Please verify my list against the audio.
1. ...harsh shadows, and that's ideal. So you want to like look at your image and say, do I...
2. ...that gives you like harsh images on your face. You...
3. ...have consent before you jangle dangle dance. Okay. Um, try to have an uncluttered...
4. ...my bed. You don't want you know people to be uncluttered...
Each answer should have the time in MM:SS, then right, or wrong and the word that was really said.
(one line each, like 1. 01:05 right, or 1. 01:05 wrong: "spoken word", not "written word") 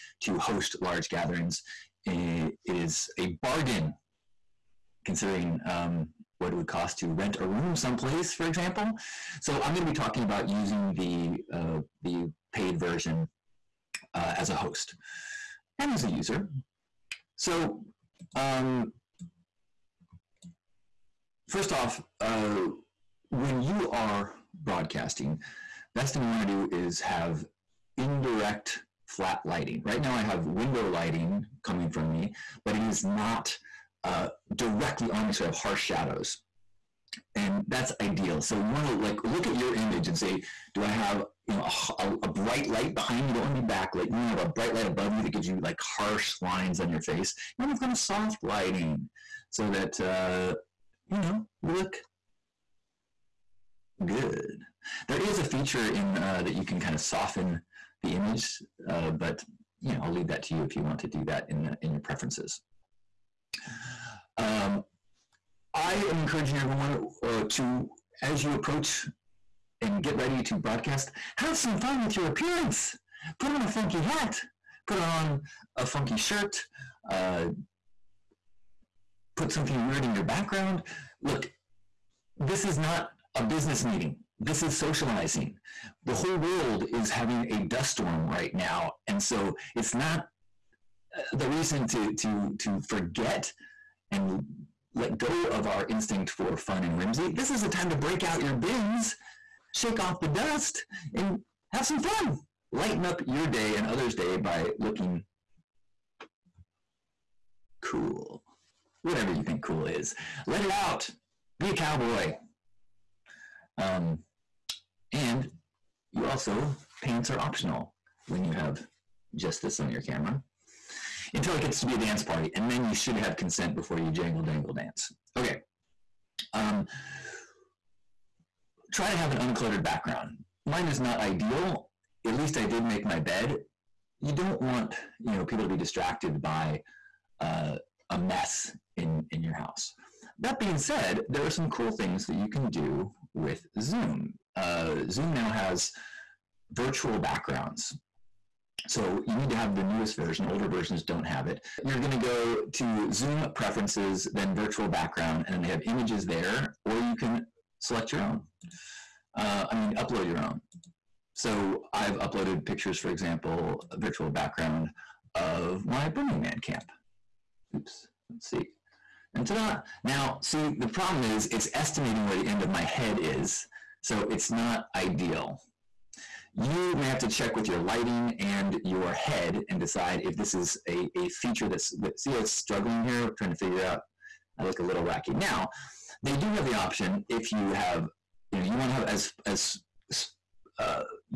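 1. 00:35 right
2. 00:45 wrong: "lines", not "images"
3. 02:03 right
4. 02:13 wrong: "distracted", not "uncluttered".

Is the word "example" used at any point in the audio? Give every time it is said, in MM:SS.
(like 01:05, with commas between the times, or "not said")
00:08, 02:43.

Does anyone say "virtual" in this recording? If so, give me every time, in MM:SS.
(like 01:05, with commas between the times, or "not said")
02:26, 02:34, 02:43.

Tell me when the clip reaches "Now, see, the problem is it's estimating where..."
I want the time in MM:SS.
02:50.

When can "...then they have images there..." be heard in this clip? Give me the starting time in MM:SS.
02:35.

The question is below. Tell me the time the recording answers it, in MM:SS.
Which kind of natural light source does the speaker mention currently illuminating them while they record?
00:30.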